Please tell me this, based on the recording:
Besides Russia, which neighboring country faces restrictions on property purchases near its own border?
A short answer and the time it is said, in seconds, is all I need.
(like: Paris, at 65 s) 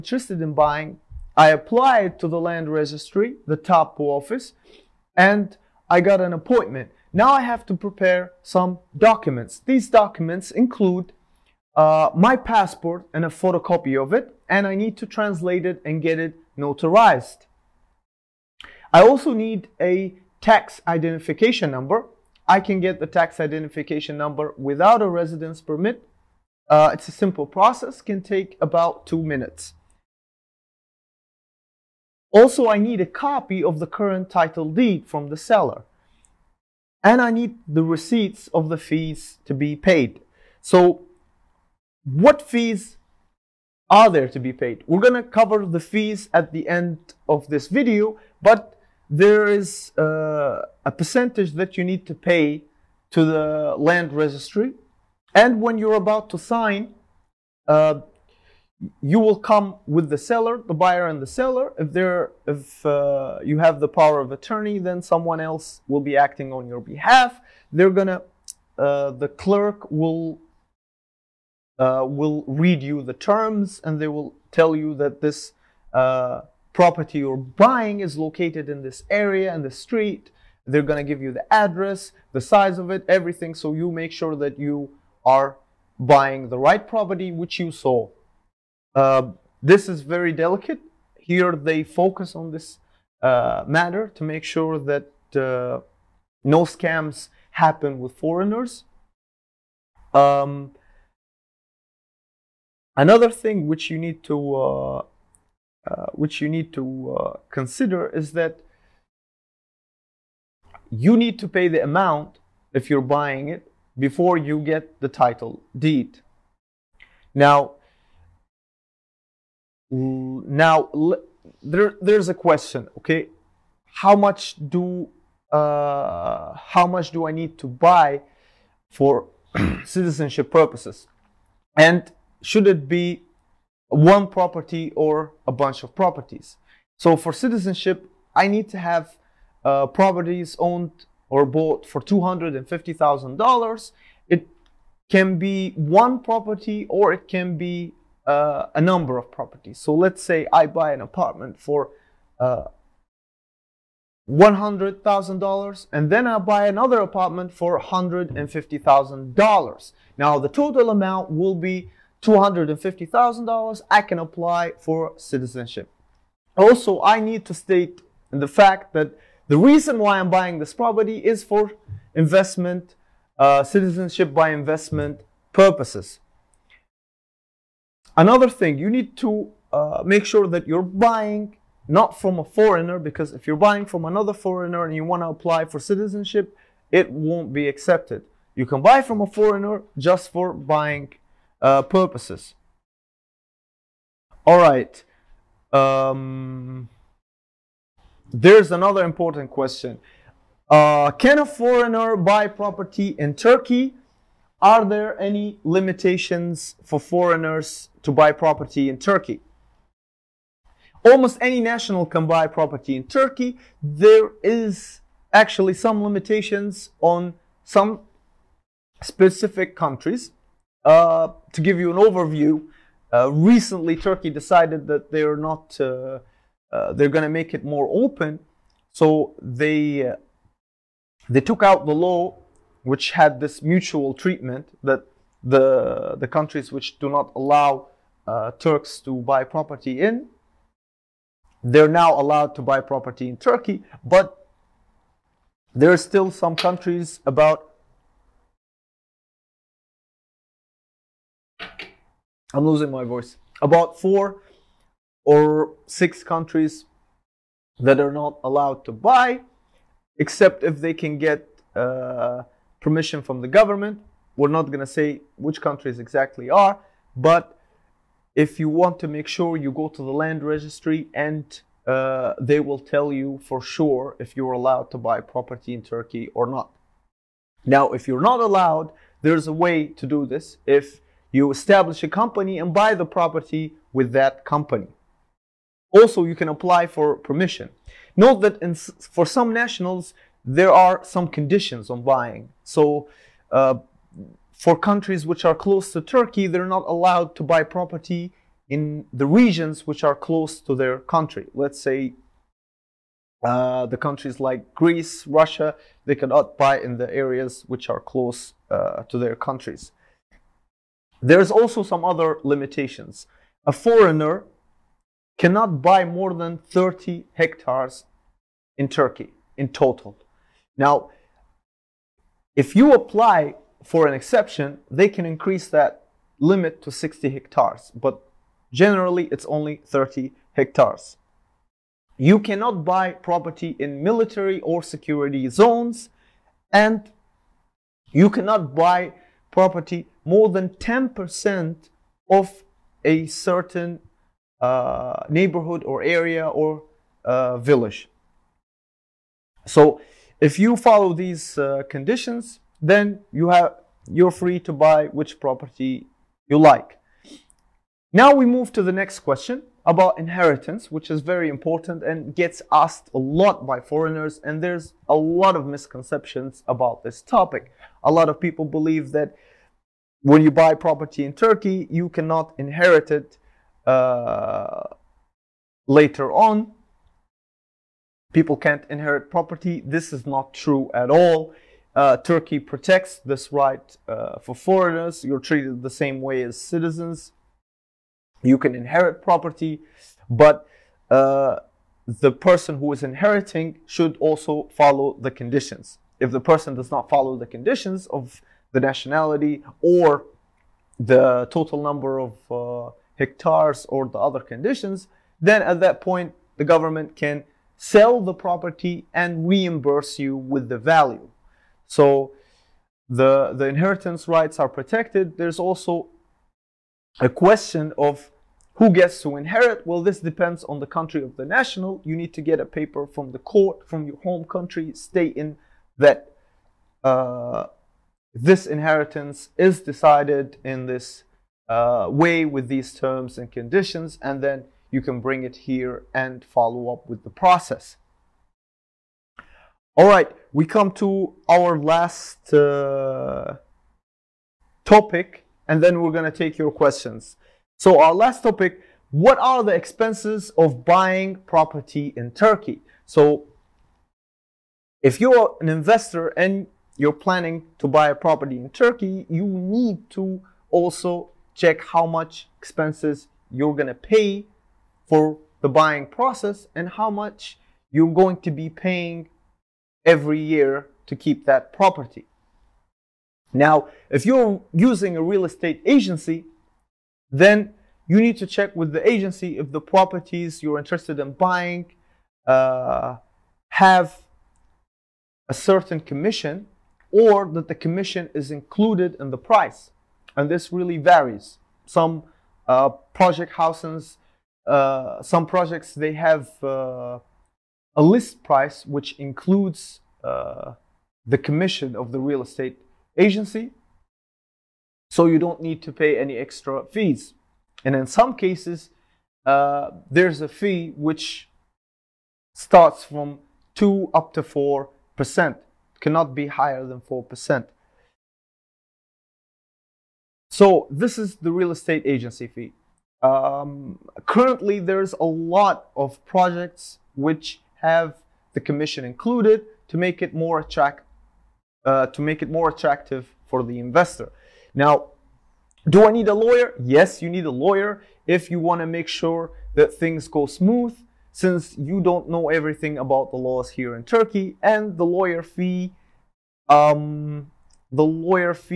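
Greece, at 304 s.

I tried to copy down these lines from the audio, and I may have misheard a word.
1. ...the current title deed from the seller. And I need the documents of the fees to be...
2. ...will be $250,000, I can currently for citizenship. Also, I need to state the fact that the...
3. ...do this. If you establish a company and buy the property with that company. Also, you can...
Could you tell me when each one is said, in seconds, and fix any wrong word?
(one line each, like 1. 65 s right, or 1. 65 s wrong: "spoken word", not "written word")
1. 33 s wrong: "receipts", not "documents"
2. 161 s wrong: "apply", not "currently"
3. 280 s right.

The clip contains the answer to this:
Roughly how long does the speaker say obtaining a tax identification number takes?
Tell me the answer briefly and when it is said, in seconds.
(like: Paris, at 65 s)
2 minutes, at 29 s.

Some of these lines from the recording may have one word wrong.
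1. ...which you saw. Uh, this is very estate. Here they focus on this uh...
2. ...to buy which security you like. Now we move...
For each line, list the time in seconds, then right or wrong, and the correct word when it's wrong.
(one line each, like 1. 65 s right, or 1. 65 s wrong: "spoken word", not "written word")
1. 87 s wrong: "delicate", not "estate"
2. 354 s wrong: "property", not "security".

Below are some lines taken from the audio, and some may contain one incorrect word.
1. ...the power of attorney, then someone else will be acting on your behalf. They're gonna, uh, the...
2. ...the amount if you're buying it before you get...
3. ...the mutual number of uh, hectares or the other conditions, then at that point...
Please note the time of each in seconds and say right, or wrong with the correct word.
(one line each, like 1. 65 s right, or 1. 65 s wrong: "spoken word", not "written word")
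1. 63 s right
2. 111 s right
3. 400 s wrong: "total", not "mutual".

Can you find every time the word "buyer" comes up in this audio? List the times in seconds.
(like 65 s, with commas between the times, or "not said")
60 s.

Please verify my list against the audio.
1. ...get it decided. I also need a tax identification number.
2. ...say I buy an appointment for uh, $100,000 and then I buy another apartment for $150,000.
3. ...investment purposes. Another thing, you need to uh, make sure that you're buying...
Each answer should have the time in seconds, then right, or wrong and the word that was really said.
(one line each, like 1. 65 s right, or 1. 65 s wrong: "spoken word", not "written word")
1. 16 s wrong: "notarized", not "decided"
2. 150 s wrong: "apartment", not "appointment"
3. 174 s right.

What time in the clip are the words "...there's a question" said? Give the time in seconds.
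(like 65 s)
121 s.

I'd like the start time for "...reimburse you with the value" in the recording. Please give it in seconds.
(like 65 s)
409 s.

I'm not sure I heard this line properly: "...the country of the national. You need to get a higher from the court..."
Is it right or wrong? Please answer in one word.
wrong.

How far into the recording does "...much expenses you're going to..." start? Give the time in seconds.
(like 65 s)
462 s.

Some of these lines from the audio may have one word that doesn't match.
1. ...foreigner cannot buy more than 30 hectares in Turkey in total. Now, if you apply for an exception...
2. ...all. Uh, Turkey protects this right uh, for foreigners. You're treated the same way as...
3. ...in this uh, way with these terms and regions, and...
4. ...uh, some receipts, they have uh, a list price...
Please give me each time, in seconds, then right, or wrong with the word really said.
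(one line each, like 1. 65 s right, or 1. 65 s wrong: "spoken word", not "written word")
1. 313 s right
2. 381 s right
3. 430 s wrong: "conditions", not "regions"
4. 494 s wrong: "projects", not "receipts".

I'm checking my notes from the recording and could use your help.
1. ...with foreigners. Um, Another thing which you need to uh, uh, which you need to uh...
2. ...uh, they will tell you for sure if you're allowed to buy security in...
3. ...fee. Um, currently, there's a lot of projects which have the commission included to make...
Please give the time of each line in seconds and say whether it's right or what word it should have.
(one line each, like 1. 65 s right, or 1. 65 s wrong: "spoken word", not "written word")
1. 97 s right
2. 271 s wrong: "property", not "security"
3. 522 s right.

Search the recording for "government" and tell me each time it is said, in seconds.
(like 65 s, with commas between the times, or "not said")
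263 s, 406 s.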